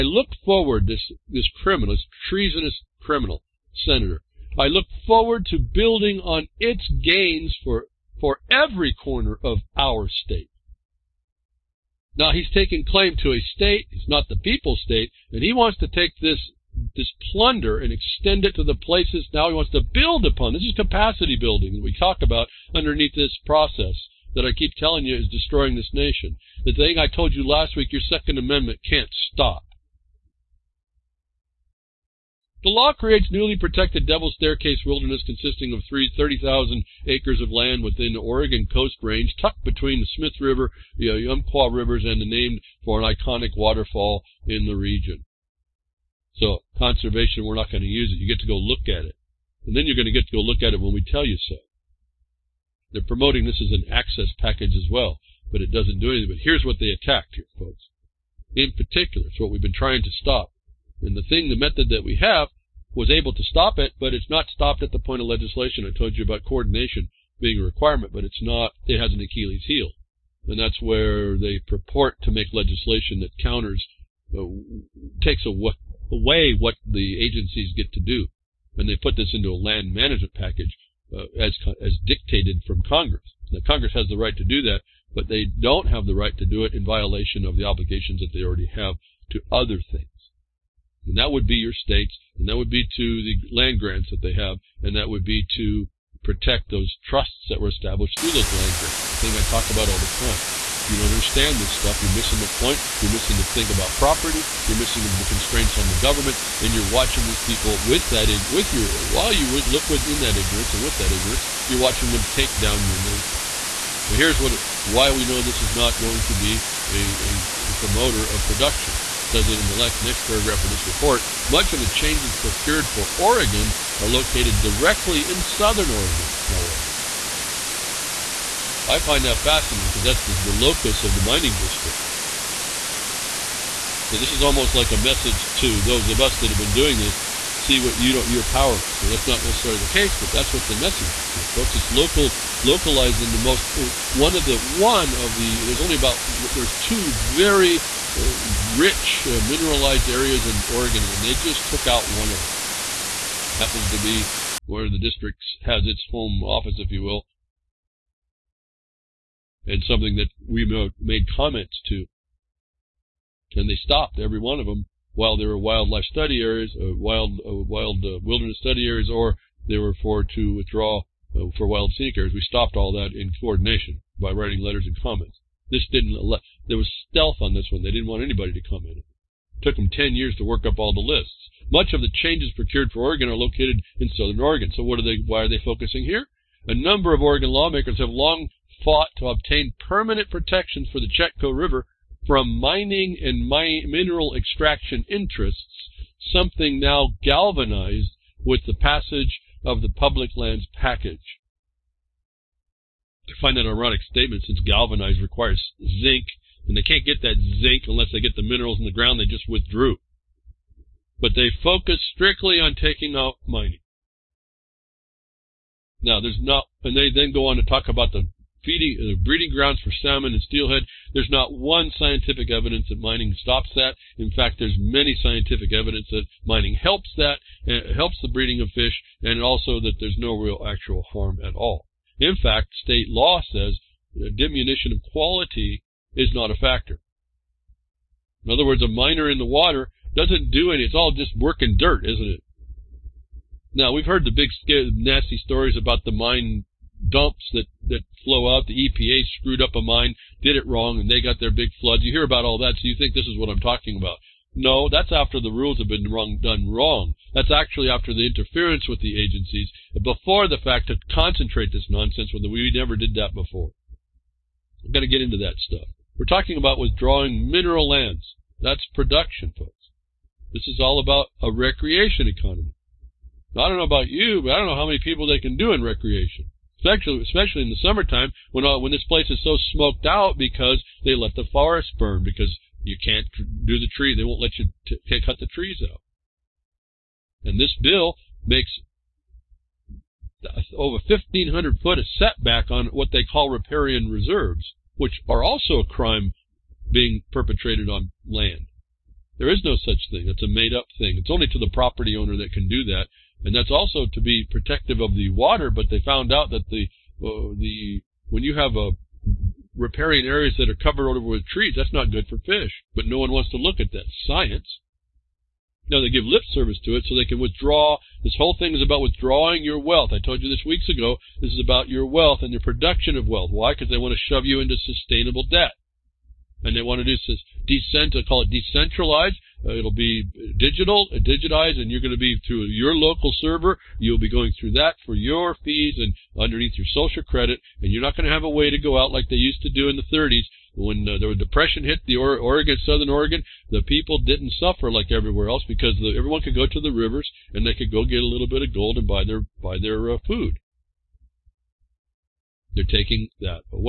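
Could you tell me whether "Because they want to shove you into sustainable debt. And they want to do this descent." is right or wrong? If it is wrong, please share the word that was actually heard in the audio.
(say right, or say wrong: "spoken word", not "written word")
right.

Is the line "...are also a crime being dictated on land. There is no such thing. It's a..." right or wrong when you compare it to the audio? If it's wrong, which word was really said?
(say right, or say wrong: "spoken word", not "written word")
wrong: "perpetrated", not "dictated".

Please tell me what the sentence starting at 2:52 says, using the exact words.
We stopped all that in coordination by writing letters and comments.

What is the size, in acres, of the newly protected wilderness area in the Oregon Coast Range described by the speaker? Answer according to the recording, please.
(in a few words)
30,000 acres.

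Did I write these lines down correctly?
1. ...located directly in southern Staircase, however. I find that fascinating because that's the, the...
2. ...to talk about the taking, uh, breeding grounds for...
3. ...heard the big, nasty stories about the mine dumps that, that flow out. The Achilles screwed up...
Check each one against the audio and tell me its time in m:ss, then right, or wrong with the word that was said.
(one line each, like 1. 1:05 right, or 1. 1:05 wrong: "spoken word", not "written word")
1. 2:04 wrong: "Oregon", not "Staircase"
2. 3:37 wrong: "feeding", not "taking"
3. 4:04 wrong: "EPA", not "Achilles".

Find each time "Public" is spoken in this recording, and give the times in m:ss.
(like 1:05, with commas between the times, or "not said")
3:19.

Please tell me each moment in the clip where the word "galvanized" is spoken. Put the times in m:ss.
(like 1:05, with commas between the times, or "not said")
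3:17, 3:24.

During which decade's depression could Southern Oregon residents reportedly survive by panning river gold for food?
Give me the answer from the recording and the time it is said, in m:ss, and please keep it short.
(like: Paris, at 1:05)
the 30s, at 5:40.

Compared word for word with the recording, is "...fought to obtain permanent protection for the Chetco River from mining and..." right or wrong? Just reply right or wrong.
right.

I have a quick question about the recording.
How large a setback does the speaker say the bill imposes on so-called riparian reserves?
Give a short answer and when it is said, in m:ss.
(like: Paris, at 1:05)
1,500 feet, at 4:51.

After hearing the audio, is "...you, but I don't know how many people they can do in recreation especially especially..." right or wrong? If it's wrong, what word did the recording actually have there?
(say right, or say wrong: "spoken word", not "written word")
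right.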